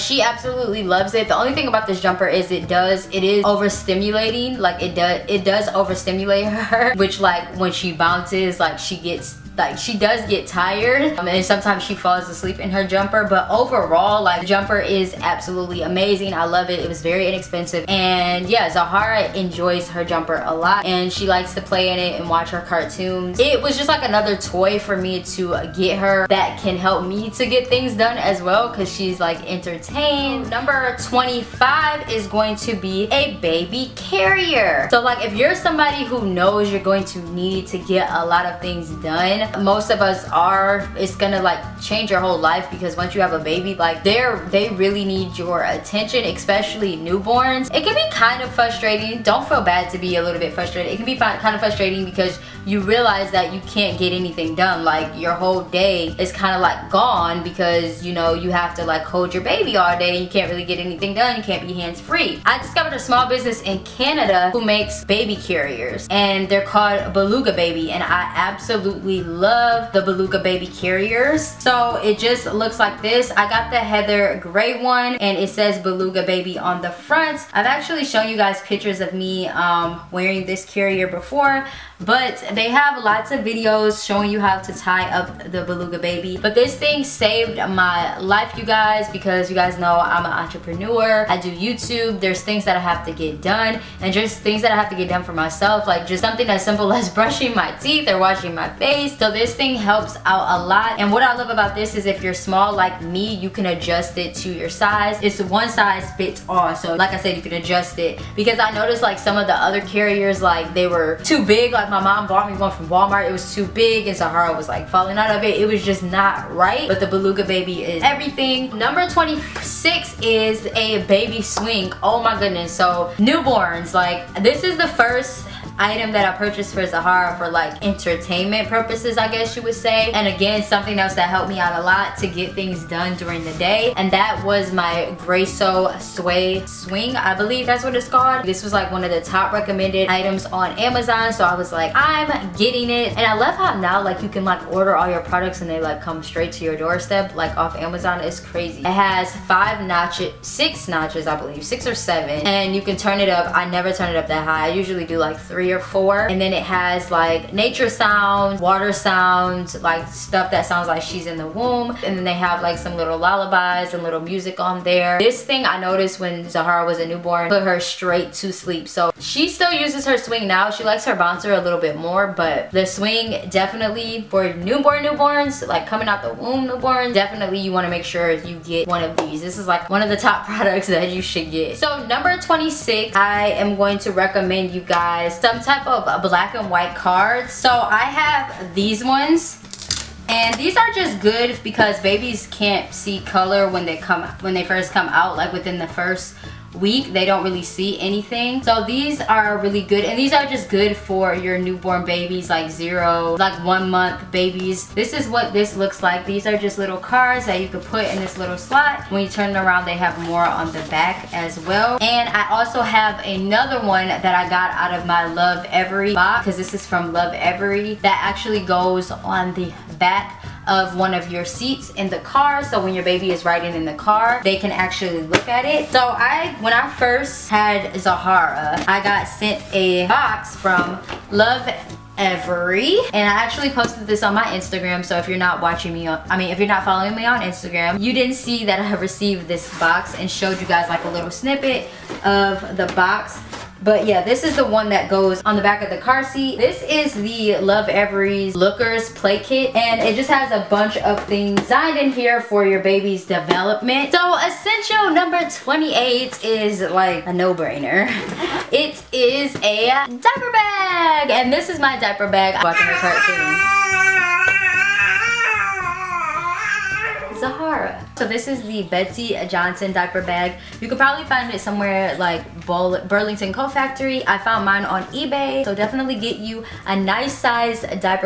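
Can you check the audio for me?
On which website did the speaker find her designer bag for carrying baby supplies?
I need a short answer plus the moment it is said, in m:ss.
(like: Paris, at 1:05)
eBay, at 4:35.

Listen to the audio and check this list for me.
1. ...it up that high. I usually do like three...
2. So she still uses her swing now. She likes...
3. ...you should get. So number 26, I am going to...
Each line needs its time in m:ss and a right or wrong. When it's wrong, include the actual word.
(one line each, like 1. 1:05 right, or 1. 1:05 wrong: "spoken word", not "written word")
1. 2:34 right
2. 2:48 right
3. 3:01 right.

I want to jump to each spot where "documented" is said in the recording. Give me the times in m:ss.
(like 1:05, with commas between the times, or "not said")
not said.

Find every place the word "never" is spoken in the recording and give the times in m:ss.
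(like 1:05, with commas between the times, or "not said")
2:33.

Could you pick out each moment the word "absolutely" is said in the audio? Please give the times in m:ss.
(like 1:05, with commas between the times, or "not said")
0:00, 0:15, 1:08.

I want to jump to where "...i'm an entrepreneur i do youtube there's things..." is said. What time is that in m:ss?
1:30.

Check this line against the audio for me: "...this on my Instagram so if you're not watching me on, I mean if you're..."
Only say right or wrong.
right.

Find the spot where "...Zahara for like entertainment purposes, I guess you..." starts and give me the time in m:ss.
2:06.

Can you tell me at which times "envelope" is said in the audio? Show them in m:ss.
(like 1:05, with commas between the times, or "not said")
not said.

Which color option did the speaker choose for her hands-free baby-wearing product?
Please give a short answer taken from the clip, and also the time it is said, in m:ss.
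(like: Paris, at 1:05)
Heather gray, at 1:13.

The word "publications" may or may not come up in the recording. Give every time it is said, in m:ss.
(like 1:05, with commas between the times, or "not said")
not said.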